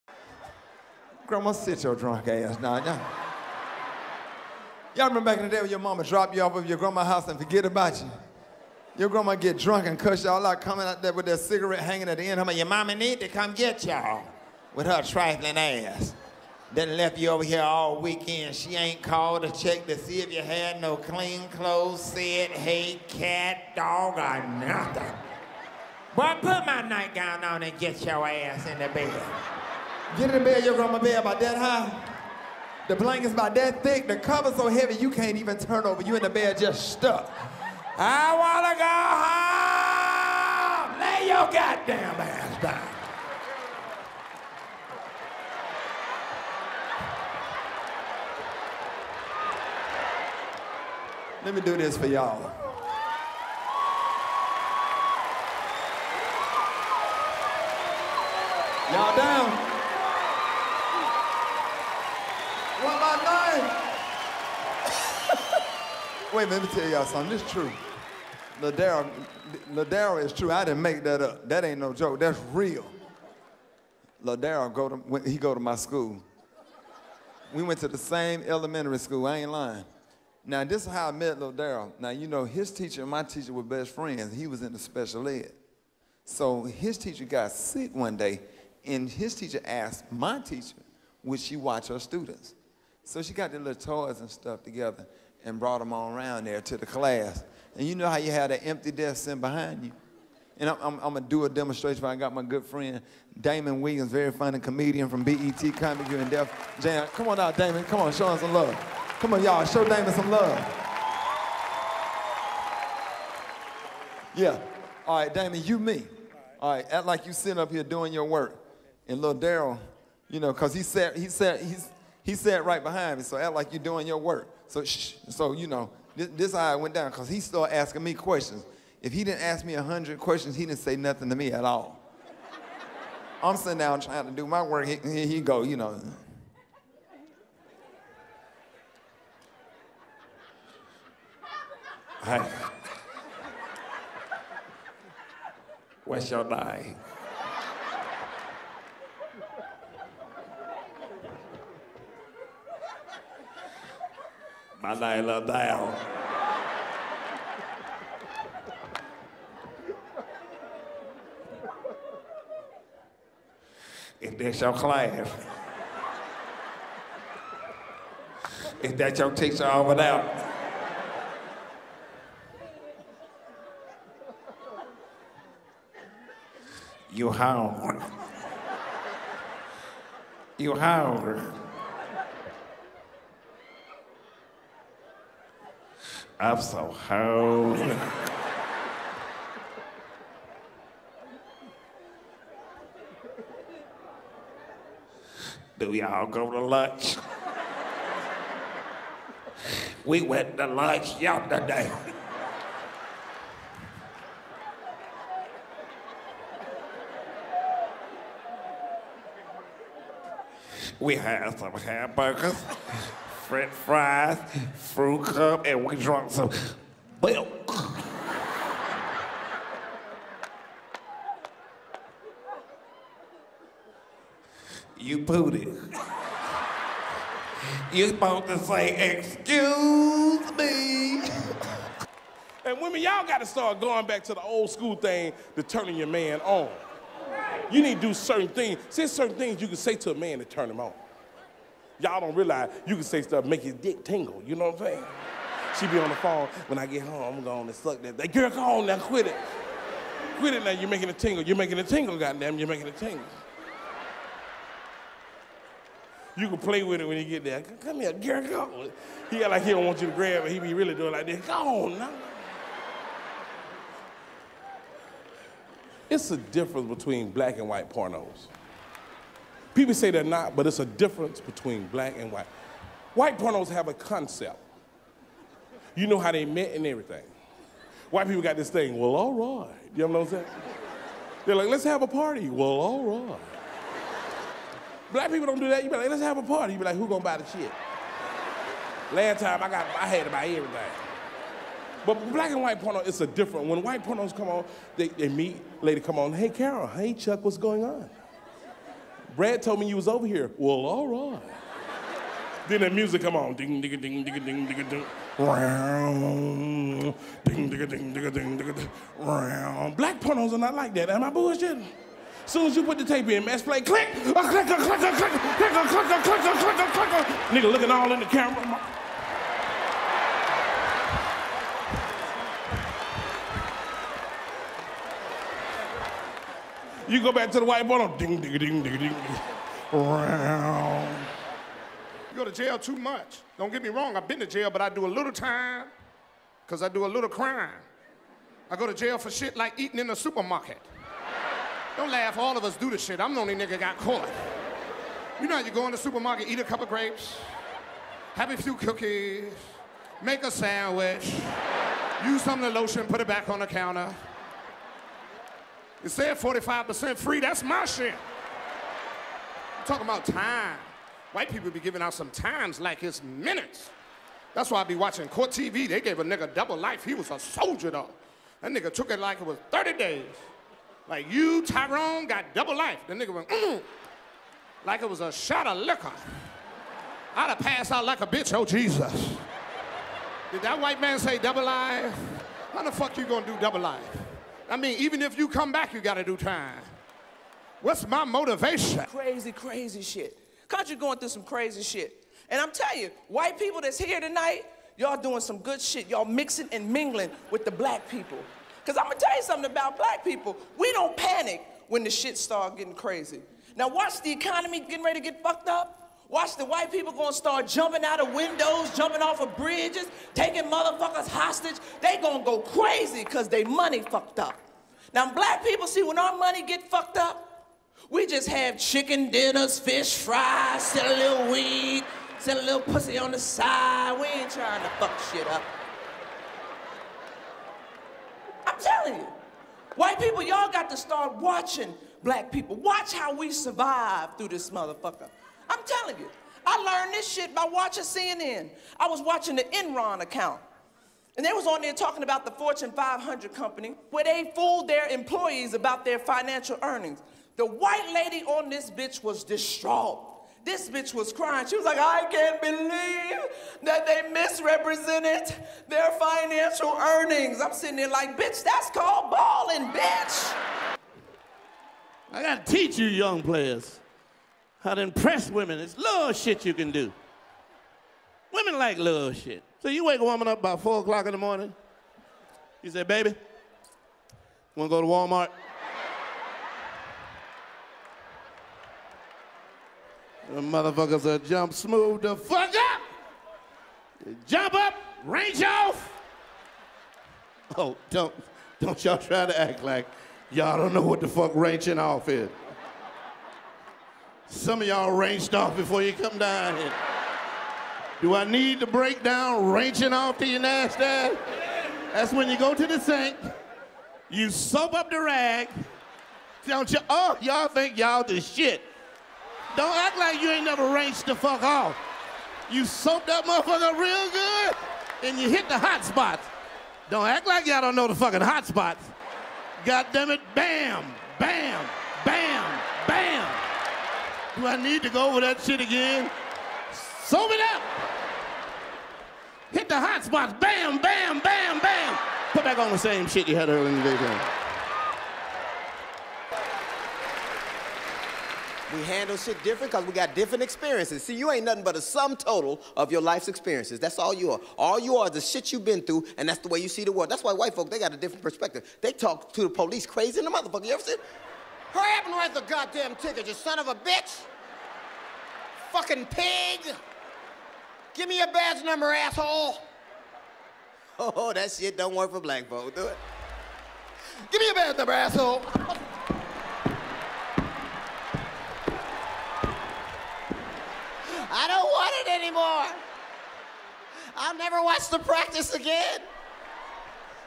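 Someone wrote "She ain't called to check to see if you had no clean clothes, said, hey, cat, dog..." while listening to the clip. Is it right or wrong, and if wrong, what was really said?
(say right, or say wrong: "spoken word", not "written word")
right.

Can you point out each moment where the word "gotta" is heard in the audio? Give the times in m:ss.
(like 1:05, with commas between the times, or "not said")
3:53, 7:42.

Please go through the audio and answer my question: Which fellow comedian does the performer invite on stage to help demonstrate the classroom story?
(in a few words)
Damon Williams.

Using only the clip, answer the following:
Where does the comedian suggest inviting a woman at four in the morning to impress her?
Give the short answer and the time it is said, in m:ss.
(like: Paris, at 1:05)
Walmart, at 7:55.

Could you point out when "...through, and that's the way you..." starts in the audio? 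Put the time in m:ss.
9:06.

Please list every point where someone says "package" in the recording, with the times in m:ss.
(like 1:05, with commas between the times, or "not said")
not said.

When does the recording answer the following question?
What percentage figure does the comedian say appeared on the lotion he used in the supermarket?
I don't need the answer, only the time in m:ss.
5:56.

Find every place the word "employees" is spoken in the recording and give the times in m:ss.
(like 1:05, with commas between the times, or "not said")
7:25.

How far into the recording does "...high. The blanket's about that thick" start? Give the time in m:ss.
0:31.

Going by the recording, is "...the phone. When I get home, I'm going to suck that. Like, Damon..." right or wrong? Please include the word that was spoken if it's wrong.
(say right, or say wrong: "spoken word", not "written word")
wrong: "Girl", not "Damon".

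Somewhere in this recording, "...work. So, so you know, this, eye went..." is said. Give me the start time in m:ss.
2:04.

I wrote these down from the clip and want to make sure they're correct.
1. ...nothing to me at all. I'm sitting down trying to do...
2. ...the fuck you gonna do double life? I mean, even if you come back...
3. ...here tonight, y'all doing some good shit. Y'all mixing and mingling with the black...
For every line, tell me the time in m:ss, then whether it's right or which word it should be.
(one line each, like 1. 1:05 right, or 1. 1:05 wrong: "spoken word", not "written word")
1. 2:10 right
2. 6:22 right
3. 6:33 right.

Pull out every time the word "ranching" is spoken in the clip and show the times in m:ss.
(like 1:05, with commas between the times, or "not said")
8:11, 8:19.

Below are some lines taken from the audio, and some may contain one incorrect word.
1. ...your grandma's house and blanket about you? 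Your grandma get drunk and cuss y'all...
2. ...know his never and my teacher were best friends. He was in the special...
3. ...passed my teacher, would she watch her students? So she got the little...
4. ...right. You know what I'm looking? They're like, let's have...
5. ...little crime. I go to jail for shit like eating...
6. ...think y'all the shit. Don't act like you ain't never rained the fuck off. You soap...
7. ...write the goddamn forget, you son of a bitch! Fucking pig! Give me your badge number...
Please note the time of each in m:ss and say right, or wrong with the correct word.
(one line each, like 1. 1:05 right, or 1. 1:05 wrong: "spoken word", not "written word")
1. 0:06 wrong: "forget", not "blanket"
2. 1:22 wrong: "teacher", not "never"
3. 1:29 wrong: "asked", not "passed"
4. 4:39 wrong: "saying", not "looking"
5. 5:37 right
6. 8:27 right
7. 9:12 wrong: "ticket", not "forget".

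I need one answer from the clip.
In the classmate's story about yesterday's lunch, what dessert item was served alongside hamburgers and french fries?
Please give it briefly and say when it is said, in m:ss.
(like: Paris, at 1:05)
fruit cup, at 3:34.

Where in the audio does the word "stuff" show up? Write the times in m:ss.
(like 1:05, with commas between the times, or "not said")
1:34, 4:03.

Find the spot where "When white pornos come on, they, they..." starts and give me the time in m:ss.
4:53.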